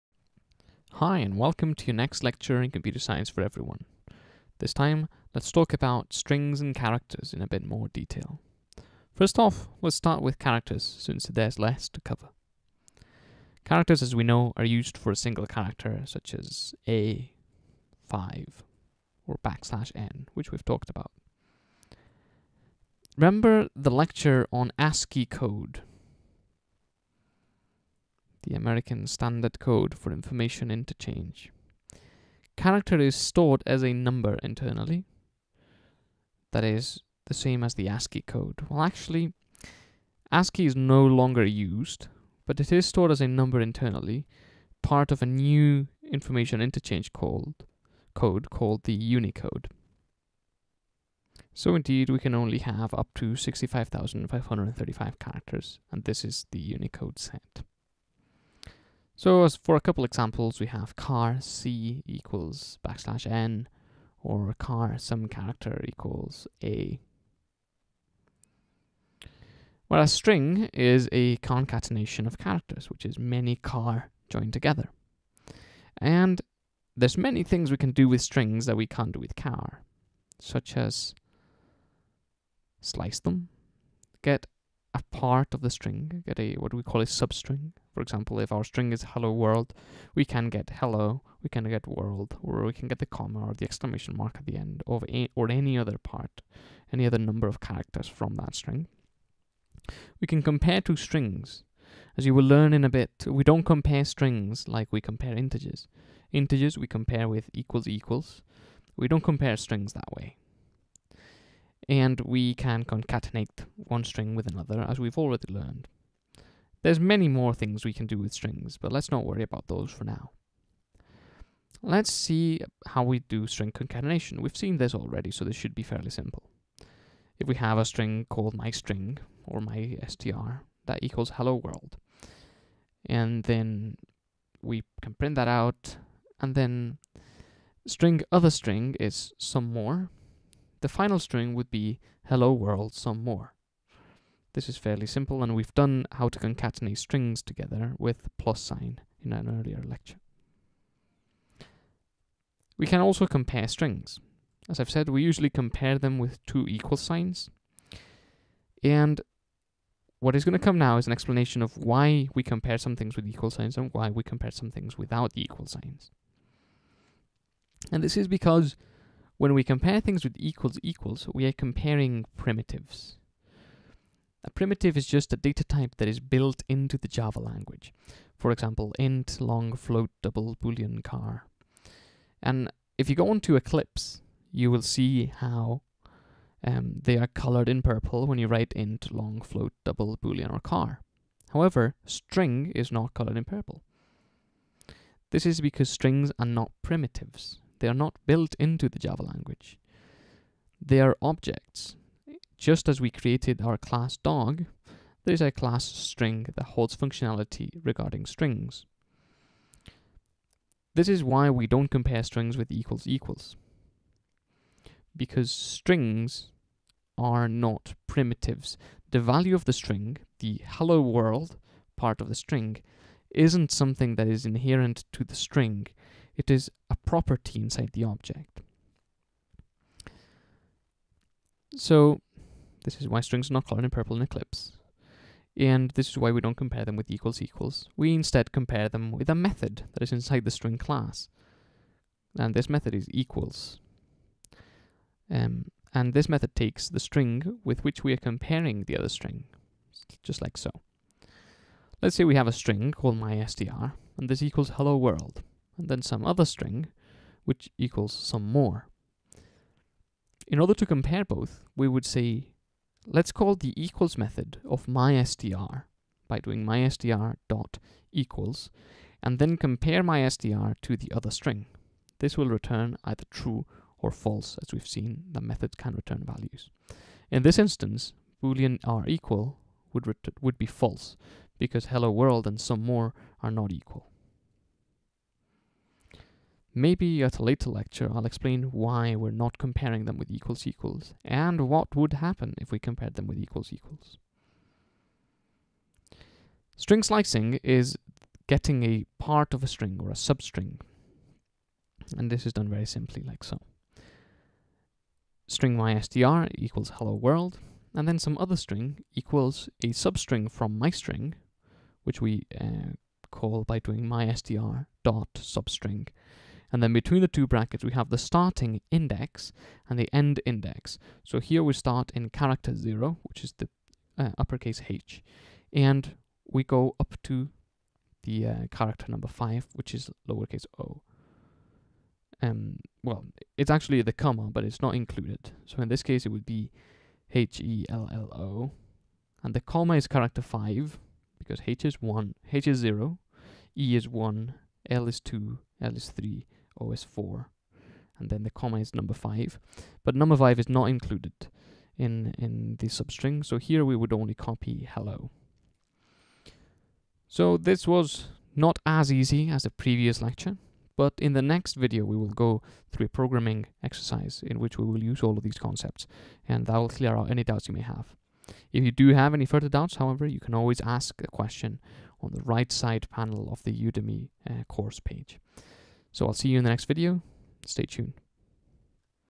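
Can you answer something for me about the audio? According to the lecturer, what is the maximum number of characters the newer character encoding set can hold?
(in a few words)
65,535.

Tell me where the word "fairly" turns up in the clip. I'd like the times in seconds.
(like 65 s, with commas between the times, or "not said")
125 s, 144 s.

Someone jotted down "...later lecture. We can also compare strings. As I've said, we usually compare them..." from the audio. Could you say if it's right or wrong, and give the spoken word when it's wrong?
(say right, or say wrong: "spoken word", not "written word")
wrong: "earlier", not "later".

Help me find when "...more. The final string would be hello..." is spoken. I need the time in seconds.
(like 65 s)
139 s.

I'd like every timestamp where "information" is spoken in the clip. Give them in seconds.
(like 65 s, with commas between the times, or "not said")
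30 s, 46 s.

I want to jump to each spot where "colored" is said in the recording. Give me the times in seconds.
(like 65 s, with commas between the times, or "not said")
187 s, 193 s, 233 s.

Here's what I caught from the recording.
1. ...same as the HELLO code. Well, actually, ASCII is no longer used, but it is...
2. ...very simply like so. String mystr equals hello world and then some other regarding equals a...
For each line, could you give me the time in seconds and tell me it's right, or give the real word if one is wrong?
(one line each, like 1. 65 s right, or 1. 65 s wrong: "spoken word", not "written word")
1. 37 s wrong: "ASCII", not "HELLO"
2. 302 s wrong: "string", not "regarding".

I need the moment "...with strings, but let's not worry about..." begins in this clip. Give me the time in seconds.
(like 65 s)
118 s.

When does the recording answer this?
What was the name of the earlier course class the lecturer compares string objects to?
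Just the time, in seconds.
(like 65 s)
204 s.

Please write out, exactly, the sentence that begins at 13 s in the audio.
Characters, as we know, are used for a single character, such as A, 5, or backslash N, which we've talked about.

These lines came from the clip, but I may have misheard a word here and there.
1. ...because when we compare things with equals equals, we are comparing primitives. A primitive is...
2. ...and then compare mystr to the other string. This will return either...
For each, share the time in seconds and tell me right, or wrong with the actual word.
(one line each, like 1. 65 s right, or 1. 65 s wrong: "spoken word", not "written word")
1. 168 s right
2. 269 s right.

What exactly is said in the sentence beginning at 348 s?
And then the comma is number 5.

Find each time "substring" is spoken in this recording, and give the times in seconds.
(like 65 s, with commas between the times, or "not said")
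87 s, 300 s, 309 s, 315 s, 352 s.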